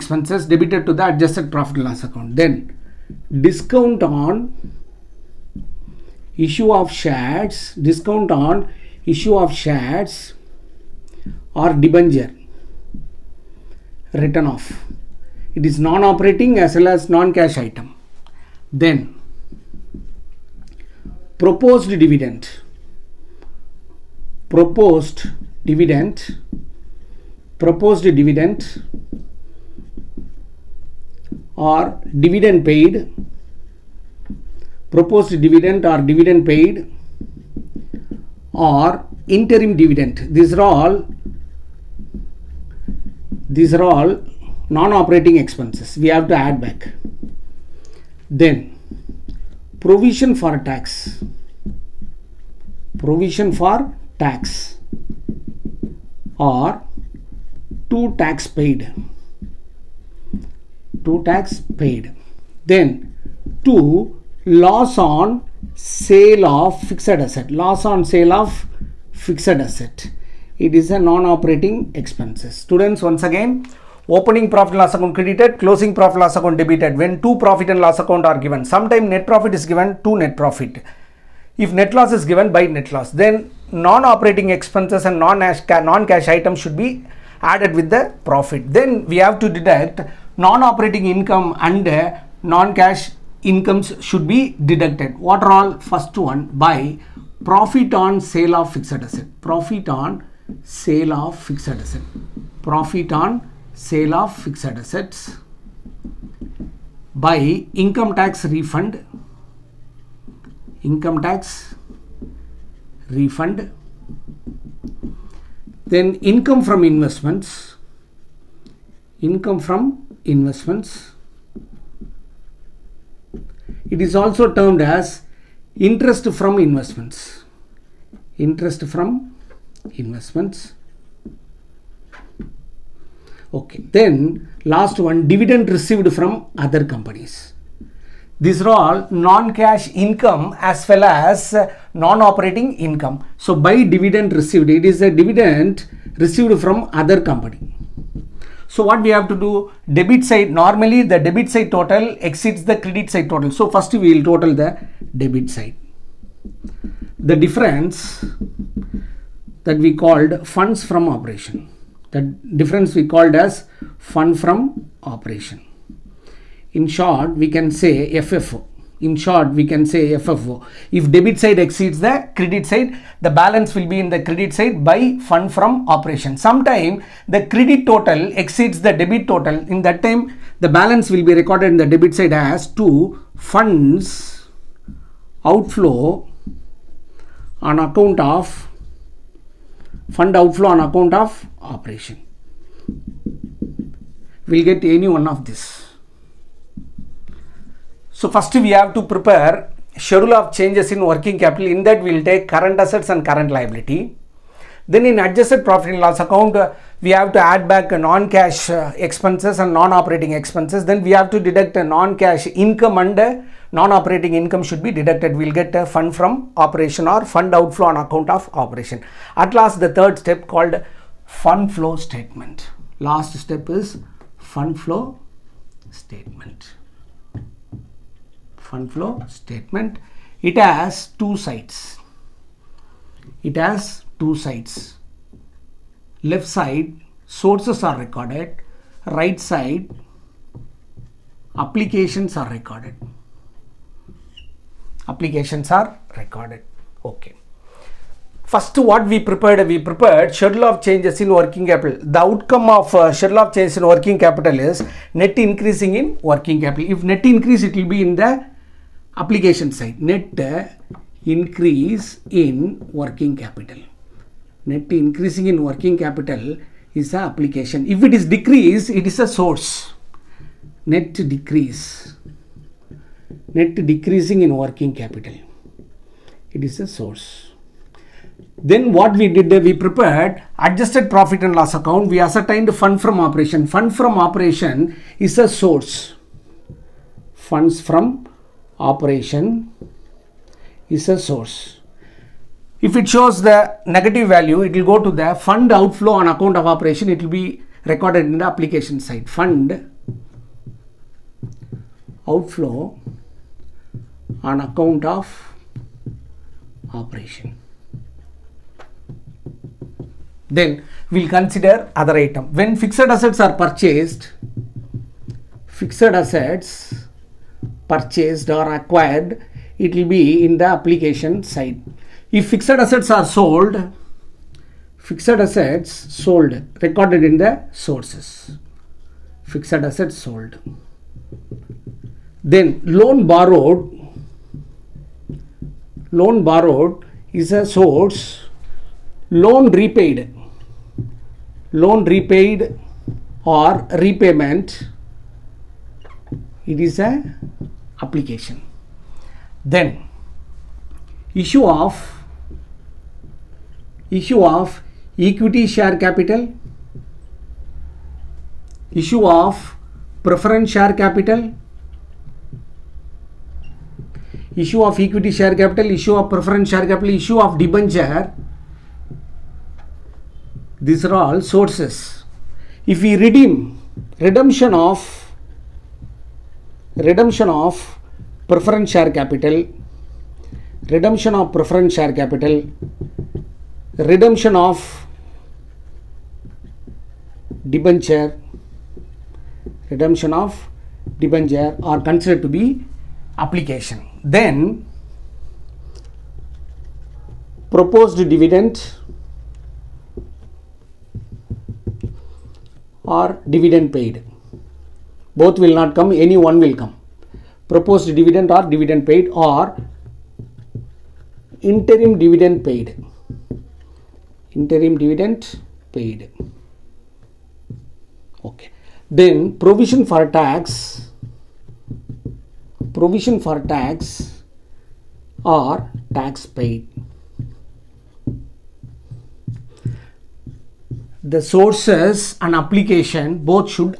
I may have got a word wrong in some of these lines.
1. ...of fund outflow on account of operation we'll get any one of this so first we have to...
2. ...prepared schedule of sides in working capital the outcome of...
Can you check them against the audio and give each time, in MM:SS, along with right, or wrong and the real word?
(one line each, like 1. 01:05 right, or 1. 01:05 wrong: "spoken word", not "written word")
1. 03:08 right
2. 04:09 wrong: "changes", not "sides".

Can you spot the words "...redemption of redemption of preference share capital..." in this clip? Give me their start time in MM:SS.
06:14.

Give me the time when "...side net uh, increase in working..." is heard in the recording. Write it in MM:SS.
04:19.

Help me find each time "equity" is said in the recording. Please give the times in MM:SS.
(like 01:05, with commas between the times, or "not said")
05:55, 06:04.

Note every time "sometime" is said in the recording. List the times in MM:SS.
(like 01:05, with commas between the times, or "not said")
01:18, 02:56.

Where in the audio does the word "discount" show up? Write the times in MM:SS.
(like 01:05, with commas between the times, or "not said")
00:03, 00:07.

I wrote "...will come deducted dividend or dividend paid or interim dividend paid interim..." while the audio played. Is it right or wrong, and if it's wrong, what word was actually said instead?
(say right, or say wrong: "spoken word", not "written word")
wrong: "proposed", not "deducted".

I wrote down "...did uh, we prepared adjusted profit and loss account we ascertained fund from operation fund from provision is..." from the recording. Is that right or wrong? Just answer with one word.
wrong.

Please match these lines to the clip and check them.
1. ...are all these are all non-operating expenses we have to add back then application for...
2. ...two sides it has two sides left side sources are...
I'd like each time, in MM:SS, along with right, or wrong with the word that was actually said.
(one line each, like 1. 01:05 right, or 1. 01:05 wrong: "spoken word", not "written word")
1. 00:40 wrong: "provision", not "application"
2. 03:51 right.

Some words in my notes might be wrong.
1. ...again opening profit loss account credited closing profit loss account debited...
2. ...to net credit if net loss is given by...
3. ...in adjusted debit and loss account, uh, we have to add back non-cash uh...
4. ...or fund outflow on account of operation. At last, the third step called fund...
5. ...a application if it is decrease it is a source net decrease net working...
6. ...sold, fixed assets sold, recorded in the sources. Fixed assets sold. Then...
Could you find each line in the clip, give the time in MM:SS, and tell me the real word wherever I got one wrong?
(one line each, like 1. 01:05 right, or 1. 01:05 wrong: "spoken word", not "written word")
1. 01:13 right
2. 01:20 wrong: "profit", not "credit"
3. 03:25 wrong: "profit", not "debit"
4. 03:37 right
5. 04:27 wrong: "decreasing", not "working"
6. 05:23 right.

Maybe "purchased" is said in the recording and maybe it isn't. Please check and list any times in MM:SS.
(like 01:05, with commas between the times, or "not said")
05:13, 05:17.